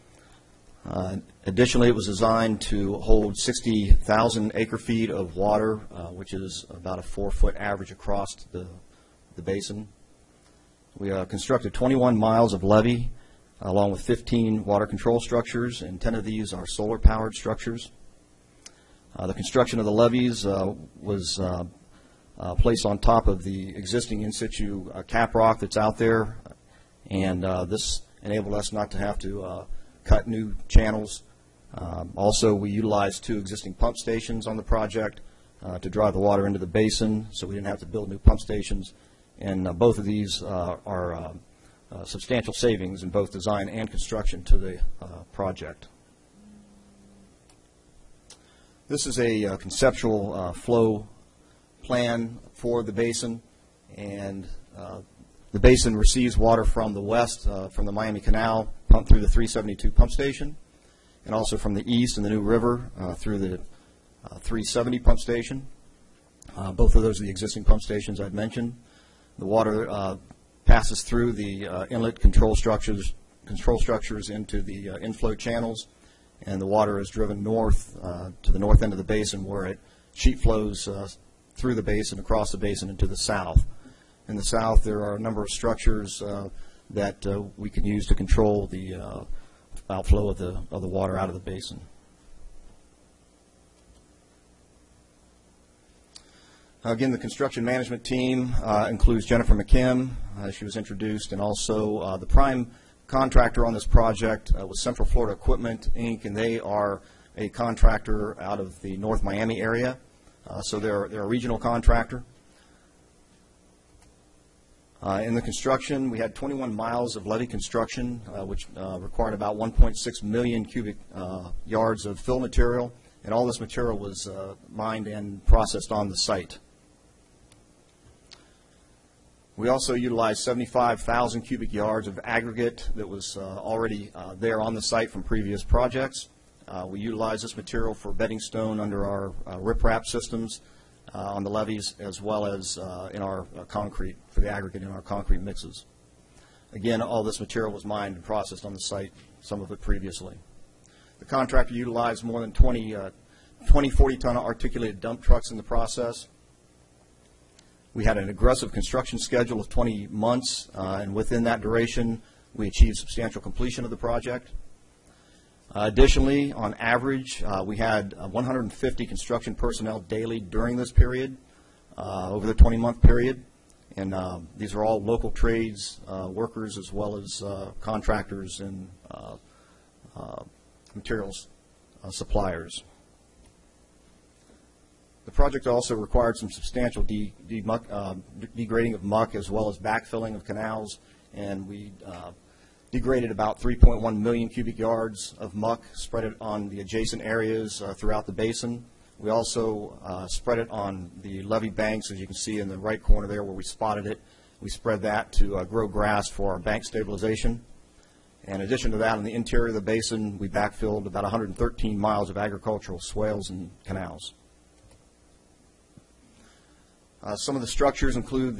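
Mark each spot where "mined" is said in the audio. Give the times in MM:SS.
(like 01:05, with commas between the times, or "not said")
02:04, 02:27.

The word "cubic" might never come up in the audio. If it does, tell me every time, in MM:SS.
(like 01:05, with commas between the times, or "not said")
02:00, 02:11, 03:14.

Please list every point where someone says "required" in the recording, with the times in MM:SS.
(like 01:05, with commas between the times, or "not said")
01:58, 03:05.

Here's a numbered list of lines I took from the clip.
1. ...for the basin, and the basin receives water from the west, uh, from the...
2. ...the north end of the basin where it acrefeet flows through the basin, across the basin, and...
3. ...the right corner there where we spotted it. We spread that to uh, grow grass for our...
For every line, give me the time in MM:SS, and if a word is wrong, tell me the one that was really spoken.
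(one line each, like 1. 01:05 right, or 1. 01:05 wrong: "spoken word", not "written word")
1. 00:52 right
2. 01:18 wrong: "sheet", not "acrefeet"
3. 03:22 right.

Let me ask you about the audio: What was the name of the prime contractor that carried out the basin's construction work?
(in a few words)
Central Florida Equipment, Inc.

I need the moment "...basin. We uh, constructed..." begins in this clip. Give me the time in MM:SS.
00:09.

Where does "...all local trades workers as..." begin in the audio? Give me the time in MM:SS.
02:54.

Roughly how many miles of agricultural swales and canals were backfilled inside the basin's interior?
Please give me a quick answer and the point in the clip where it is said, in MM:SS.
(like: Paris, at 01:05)
113, at 03:31.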